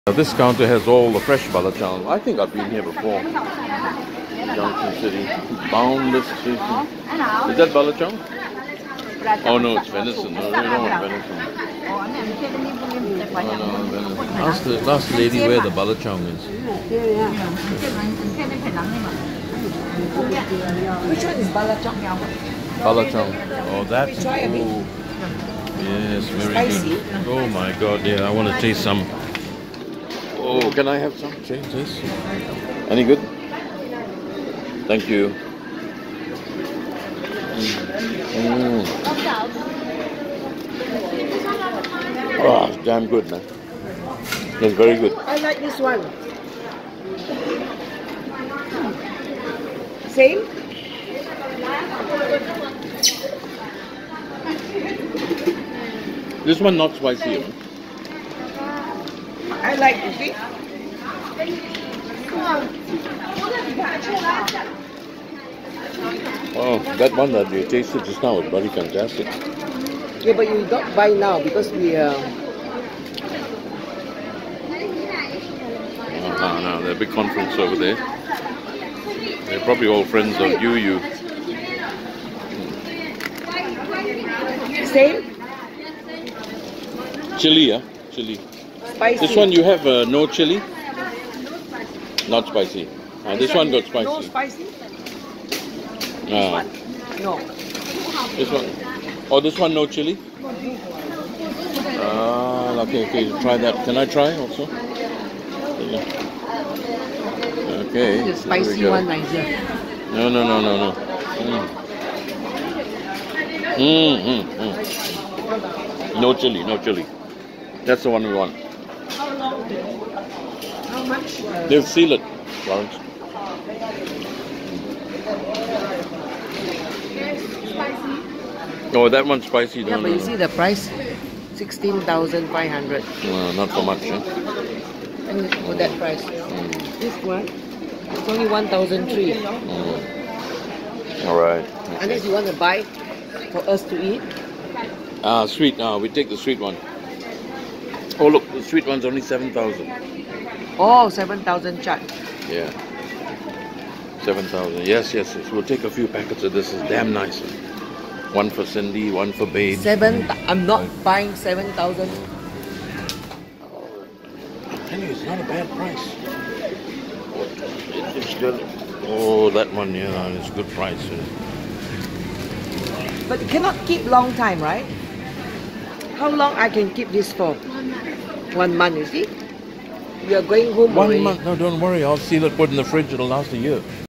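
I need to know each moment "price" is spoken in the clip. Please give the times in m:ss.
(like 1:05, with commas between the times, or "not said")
2:10, 2:15, 2:45, 2:50.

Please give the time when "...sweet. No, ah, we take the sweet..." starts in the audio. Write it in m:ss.
2:25.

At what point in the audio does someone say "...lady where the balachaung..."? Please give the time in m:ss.
0:15.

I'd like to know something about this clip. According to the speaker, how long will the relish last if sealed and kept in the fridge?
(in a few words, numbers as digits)
a year.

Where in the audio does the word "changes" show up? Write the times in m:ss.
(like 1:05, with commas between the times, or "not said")
0:31.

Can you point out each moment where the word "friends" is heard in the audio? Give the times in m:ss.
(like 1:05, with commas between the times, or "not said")
1:20.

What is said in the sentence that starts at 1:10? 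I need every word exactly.
Yeah, but you don't buy now because we.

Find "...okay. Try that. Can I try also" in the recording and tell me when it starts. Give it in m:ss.
1:43.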